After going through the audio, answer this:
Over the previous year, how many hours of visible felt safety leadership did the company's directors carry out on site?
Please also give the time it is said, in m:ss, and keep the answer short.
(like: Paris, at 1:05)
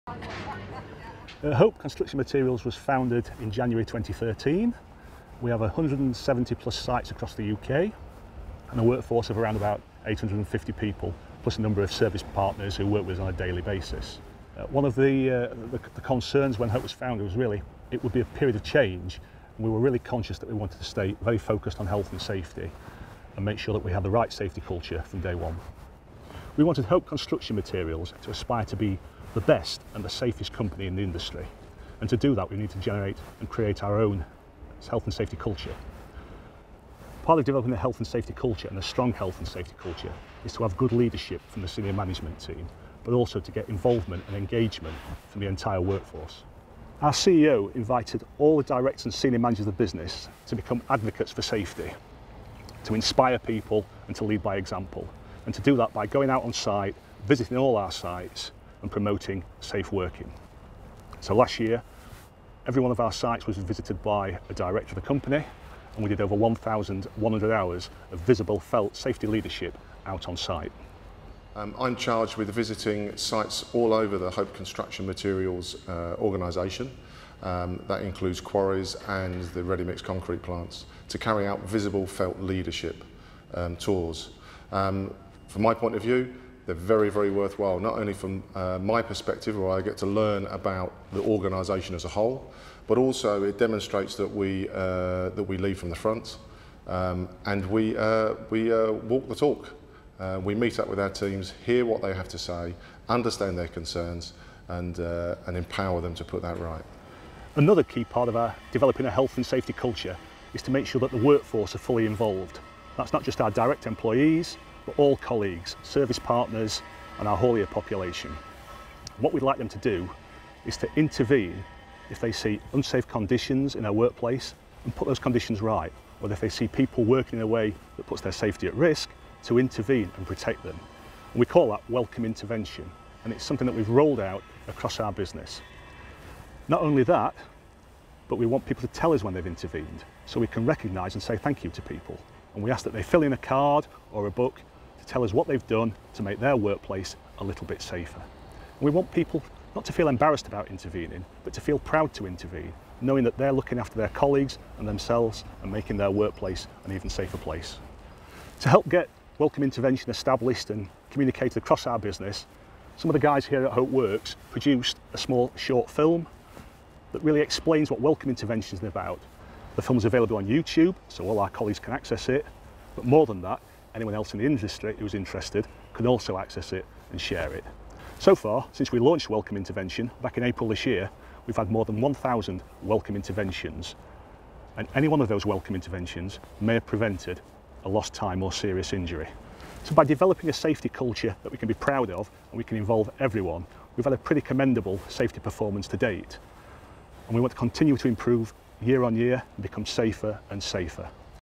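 1,100, at 1:06.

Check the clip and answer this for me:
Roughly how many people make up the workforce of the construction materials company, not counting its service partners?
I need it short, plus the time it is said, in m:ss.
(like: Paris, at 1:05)
850, at 0:10.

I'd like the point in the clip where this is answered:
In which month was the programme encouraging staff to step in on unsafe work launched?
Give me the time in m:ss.
3:00.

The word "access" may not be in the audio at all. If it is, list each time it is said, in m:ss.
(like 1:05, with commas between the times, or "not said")
2:51, 2:56.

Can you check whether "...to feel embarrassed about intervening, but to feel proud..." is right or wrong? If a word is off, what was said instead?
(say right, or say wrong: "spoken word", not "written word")
right.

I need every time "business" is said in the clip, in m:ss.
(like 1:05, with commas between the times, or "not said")
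0:49, 2:15, 2:41.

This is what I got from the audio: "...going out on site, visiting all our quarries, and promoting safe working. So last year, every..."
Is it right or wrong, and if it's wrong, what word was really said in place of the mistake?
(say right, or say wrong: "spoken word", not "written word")
wrong: "sites", not "quarries".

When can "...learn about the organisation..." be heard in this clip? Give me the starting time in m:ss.
1:30.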